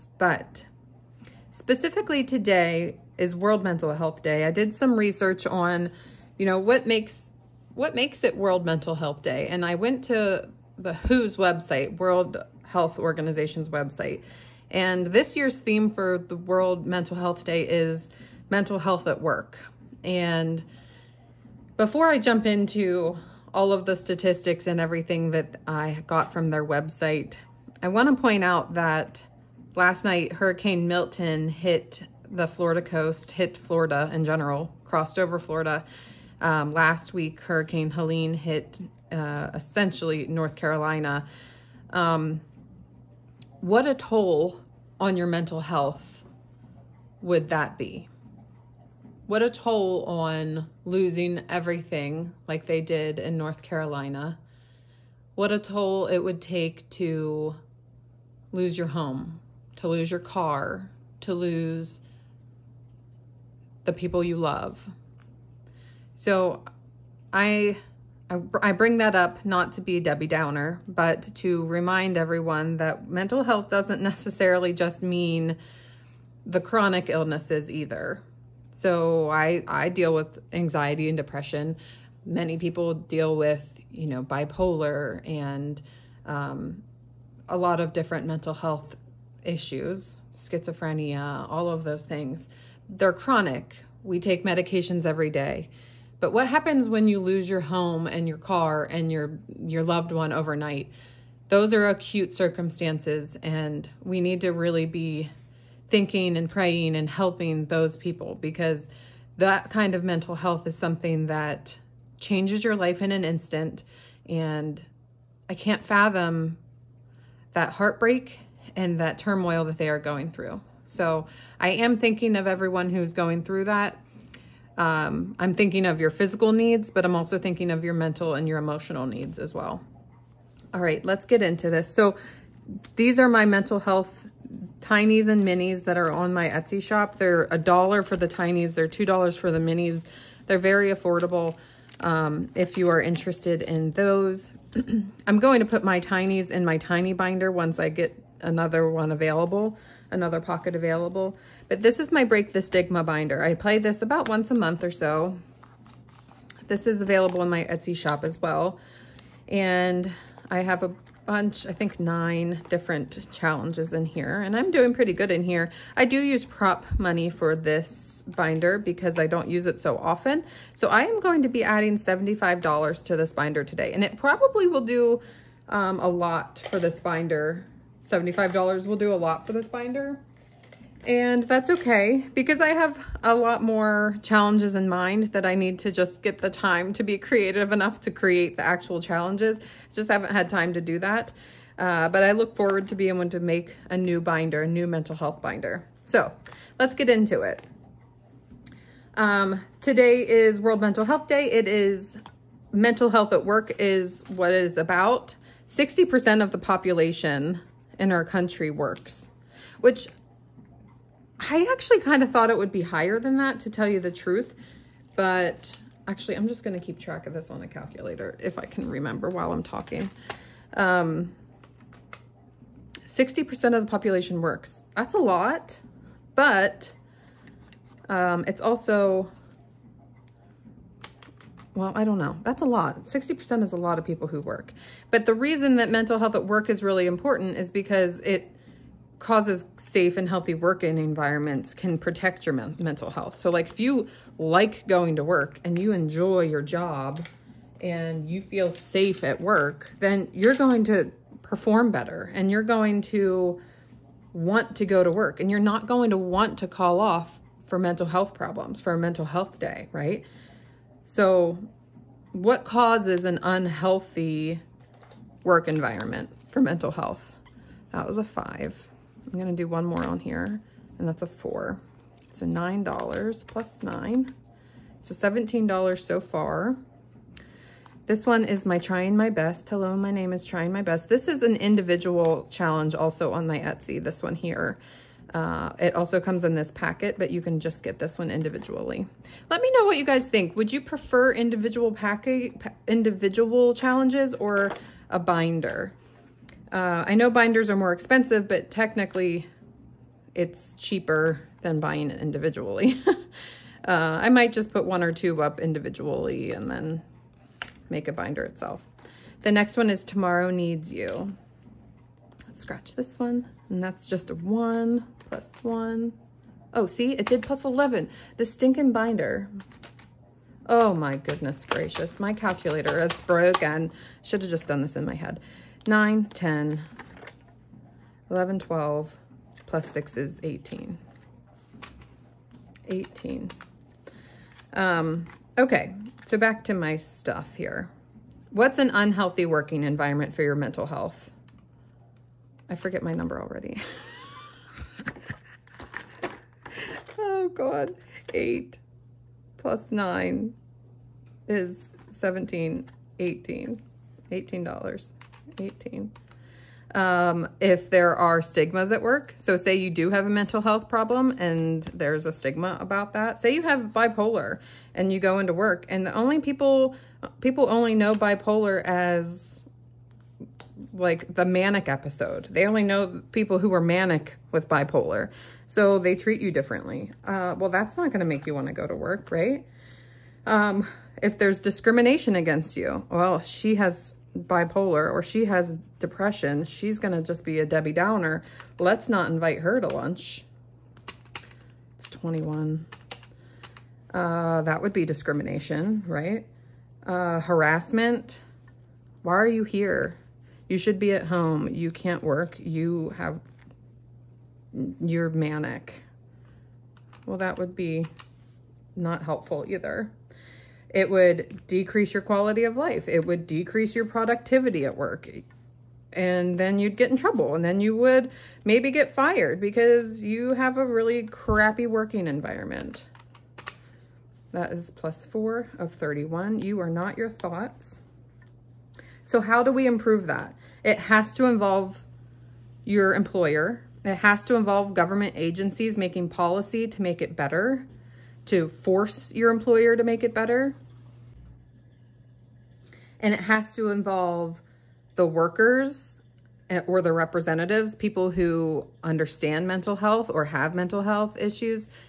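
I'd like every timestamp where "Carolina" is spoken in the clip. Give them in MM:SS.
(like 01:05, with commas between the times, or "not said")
00:40, 00:53.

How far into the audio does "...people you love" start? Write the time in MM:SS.
01:03.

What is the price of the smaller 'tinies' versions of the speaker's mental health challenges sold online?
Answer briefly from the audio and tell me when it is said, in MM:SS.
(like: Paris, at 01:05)
$1, at 02:17.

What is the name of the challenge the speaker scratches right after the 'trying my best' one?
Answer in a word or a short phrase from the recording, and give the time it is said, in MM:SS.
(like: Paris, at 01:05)
Tomorrow Needs You, at 05:10.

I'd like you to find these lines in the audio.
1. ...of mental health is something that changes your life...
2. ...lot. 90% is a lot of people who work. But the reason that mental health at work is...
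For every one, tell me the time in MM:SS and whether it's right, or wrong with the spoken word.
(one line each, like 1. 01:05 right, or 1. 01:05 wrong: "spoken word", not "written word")
1. 01:49 right
2. 03:52 wrong: "60", not "90".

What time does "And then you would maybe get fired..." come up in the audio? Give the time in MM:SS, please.
06:57.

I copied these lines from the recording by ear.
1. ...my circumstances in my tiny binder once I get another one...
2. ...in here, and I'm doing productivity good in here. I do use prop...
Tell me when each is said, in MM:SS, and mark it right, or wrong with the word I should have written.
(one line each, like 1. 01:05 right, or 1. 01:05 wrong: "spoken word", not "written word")
1. 02:25 wrong: "tinies", not "circumstances"
2. 02:43 wrong: "pretty", not "productivity".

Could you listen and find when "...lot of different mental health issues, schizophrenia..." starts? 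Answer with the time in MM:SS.
01:27.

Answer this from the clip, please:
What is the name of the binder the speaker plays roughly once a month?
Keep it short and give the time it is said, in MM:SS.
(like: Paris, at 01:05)
Break the Stigma, at 02:32.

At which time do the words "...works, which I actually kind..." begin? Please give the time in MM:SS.
03:28.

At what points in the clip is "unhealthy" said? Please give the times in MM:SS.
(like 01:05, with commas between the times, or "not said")
04:23, 05:38.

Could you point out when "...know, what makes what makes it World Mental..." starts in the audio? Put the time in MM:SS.
00:06.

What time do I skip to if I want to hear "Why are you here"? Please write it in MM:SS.
06:39.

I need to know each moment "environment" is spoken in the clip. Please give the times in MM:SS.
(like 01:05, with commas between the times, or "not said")
04:00, 04:25, 05:39, 07:02.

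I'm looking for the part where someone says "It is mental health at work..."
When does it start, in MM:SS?
03:21.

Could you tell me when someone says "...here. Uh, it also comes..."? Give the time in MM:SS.
04:44.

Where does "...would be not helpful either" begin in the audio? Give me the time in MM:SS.
06:47.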